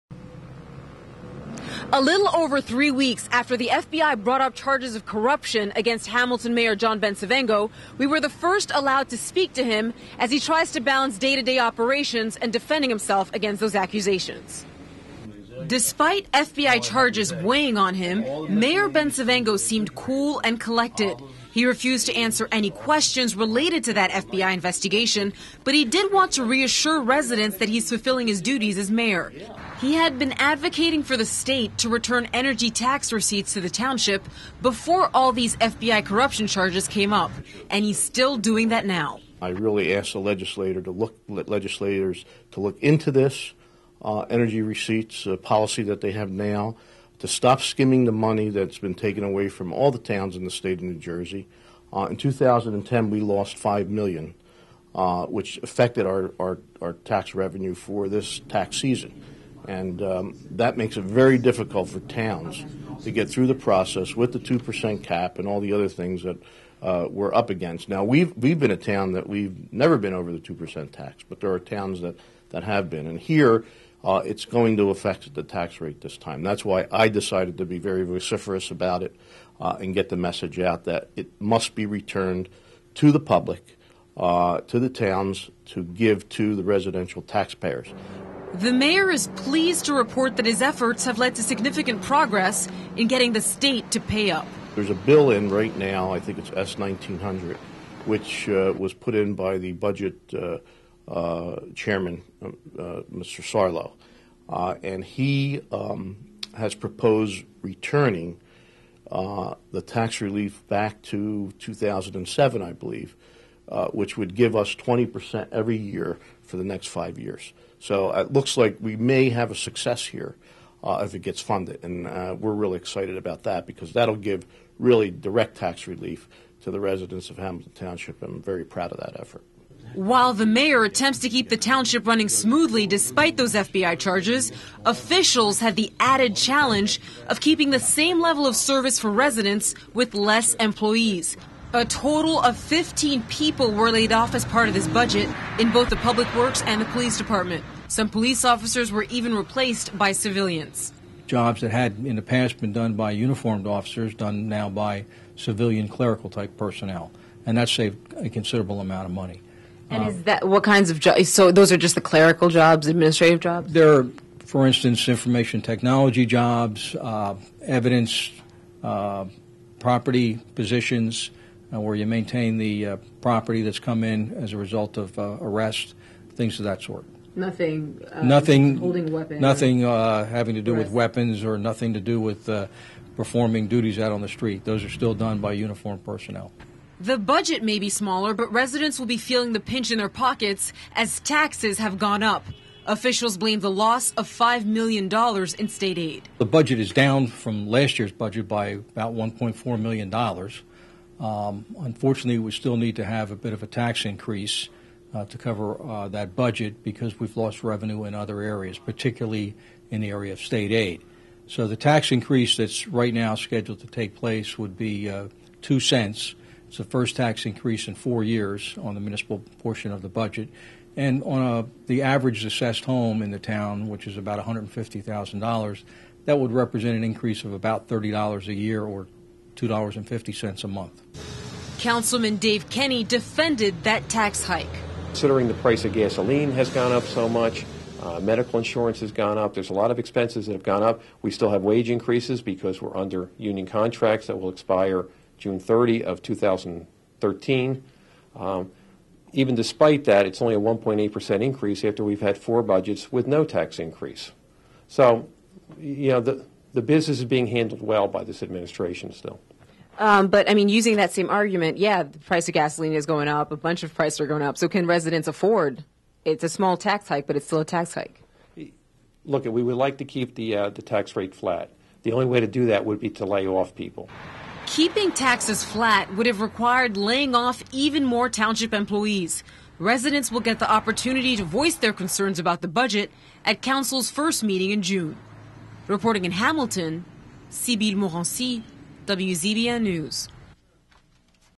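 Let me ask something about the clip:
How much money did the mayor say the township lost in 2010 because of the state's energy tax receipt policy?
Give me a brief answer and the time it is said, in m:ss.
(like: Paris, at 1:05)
5 million, at 0:53.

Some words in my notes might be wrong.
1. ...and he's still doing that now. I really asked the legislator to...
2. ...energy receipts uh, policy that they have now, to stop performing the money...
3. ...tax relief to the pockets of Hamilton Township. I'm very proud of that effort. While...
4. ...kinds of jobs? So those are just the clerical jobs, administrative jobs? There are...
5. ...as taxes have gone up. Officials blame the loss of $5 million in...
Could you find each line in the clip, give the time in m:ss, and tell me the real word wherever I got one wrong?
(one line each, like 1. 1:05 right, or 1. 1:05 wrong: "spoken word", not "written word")
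1. 0:37 right
2. 0:44 wrong: "skimming", not "performing"
3. 2:05 wrong: "residents", not "pockets"
4. 2:40 right
5. 3:10 right.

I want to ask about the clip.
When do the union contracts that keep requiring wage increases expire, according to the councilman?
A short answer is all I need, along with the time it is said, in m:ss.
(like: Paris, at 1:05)
June 30, 2013, at 4:05.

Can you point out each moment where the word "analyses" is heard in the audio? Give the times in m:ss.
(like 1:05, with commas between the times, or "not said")
not said.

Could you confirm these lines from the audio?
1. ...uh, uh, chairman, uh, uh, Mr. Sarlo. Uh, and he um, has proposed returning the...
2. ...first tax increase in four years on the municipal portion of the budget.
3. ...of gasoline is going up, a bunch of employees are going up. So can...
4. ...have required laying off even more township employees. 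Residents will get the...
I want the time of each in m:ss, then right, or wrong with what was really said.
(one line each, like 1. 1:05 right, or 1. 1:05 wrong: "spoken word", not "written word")
1. 1:40 right
2. 3:36 right
3. 4:22 wrong: "prices", not "employees"
4. 4:36 right.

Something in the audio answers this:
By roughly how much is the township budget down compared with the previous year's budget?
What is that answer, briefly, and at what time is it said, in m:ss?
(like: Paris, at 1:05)
$1.4 million, at 3:19.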